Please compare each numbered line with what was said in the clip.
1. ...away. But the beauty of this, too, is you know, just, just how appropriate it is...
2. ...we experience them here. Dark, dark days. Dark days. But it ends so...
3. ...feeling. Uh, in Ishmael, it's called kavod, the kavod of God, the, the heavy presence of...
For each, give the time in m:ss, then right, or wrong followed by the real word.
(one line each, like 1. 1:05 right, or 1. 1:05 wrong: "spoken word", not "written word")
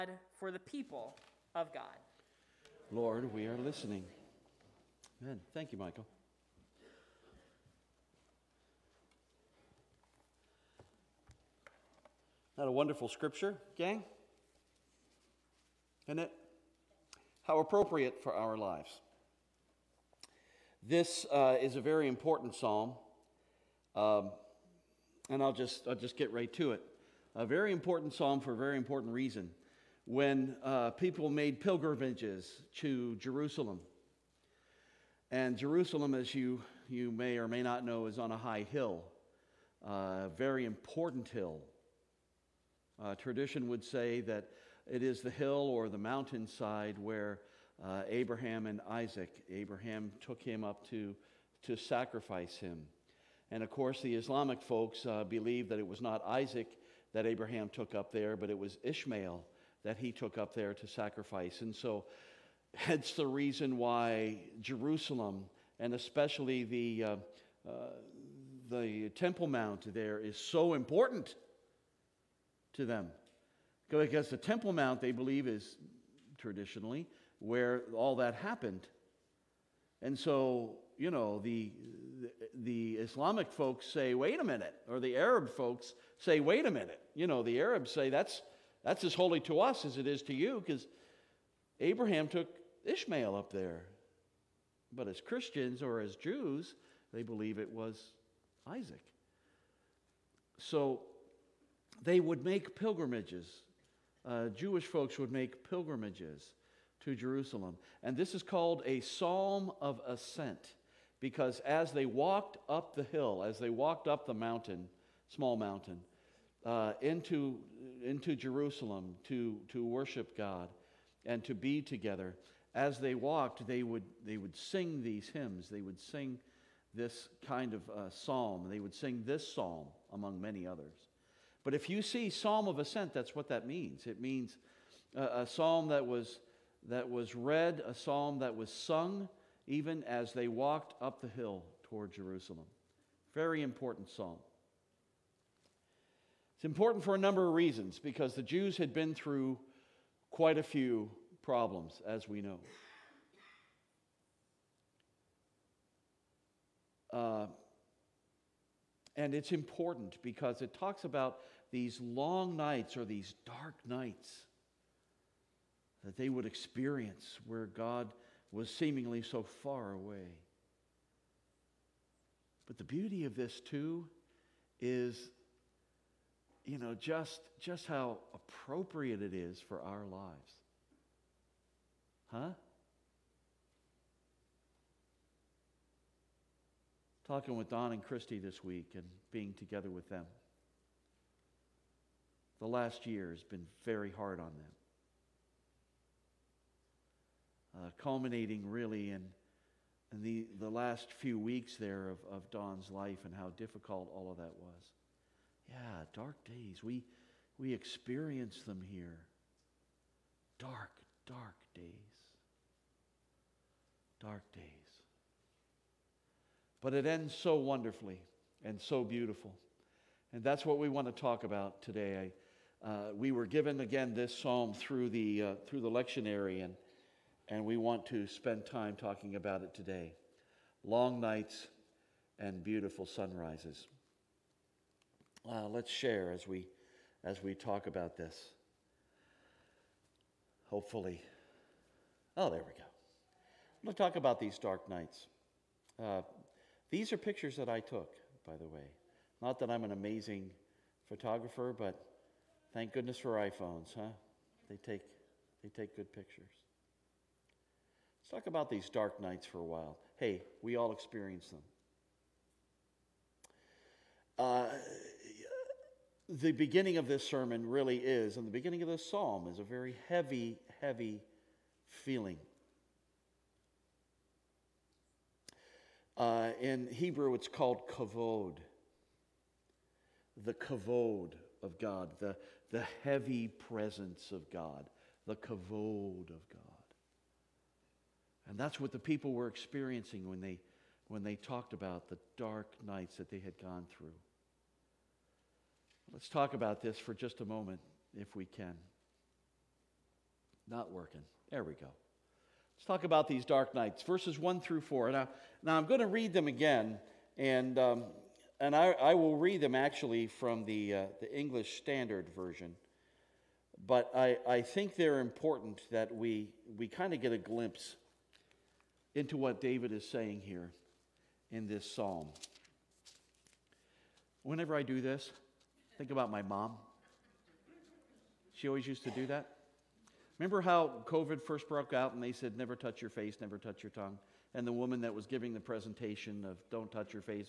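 1. 2:49 right
2. 3:27 right
3. 4:32 wrong: "Hebrew", not "Ishmael".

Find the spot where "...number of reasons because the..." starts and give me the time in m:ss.
2:27.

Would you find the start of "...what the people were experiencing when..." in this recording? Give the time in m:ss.
4:48.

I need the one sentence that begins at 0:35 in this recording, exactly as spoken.
And Jerusalem, as you, you may or may not know, is on a high hill, uh, a very important hill.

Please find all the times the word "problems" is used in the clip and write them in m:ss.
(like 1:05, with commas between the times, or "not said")
2:31.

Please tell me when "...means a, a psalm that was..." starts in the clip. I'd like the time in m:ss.
2:14.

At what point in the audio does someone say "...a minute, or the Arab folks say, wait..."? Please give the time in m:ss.
1:24.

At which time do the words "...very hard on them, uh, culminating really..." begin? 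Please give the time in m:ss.
3:13.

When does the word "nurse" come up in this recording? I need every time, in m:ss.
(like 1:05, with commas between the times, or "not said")
not said.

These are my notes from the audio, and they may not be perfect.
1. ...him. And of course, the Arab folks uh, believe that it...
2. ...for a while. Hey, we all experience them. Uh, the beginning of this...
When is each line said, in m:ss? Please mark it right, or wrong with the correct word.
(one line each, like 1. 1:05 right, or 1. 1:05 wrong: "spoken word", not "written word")
1. 0:52 wrong: "Islamic", not "Arab"
2. 4:19 right.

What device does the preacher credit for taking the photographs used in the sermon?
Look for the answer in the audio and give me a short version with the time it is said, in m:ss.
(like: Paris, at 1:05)
iPhones, at 4:13.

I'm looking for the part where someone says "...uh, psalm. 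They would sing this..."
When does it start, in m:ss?
2:07.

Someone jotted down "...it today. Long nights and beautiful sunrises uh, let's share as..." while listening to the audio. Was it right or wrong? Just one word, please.
right.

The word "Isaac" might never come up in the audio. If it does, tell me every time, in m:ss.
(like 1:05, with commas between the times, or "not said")
0:48, 0:56, 1:38.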